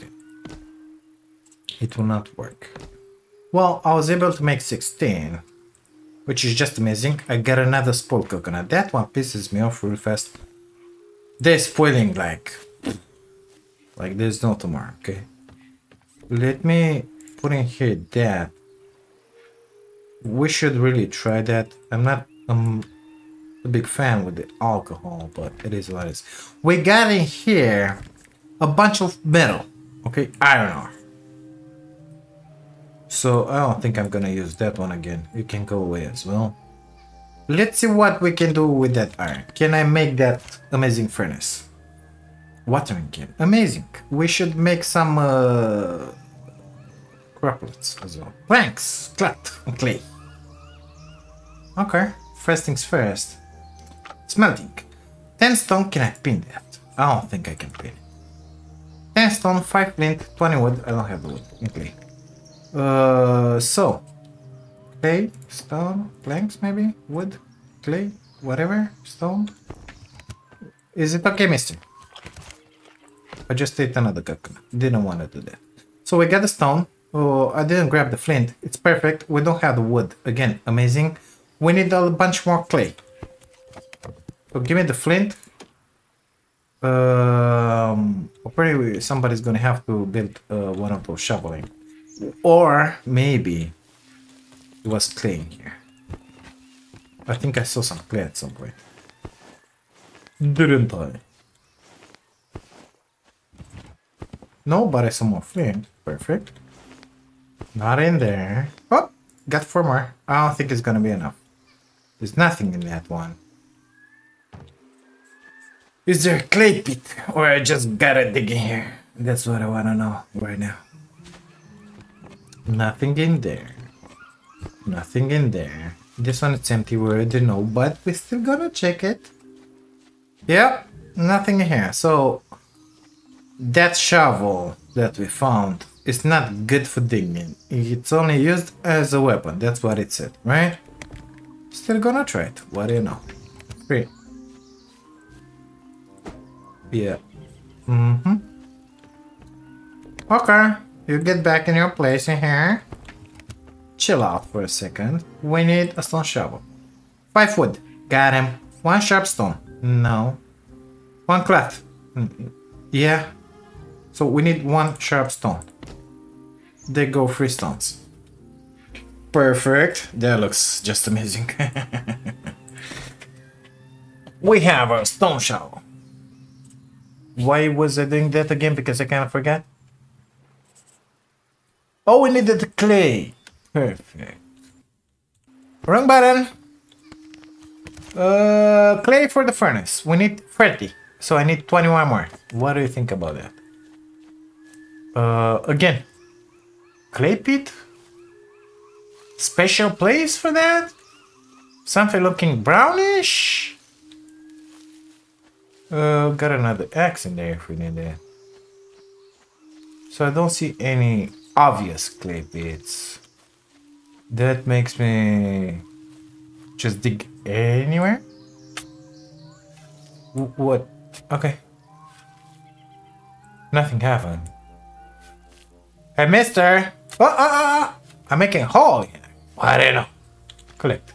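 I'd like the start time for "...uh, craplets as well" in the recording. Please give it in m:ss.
0:45.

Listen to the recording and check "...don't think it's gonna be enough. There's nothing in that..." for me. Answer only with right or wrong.
right.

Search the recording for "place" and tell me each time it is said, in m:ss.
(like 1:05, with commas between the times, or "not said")
2:31, 3:19.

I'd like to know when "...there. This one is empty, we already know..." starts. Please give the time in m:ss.
2:05.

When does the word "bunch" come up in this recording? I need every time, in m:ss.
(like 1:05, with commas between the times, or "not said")
0:28, 1:22.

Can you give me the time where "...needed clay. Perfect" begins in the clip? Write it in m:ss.
3:02.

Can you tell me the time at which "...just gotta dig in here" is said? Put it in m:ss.
1:57.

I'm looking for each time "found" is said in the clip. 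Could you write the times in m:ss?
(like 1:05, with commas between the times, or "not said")
2:15.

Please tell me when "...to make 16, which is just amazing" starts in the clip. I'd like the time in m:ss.
0:04.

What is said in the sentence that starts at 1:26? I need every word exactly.
Um, probably somebody's gonna have to build uh, one of those shoveling.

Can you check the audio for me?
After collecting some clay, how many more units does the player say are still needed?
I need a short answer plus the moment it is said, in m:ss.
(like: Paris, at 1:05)
21, at 3:11.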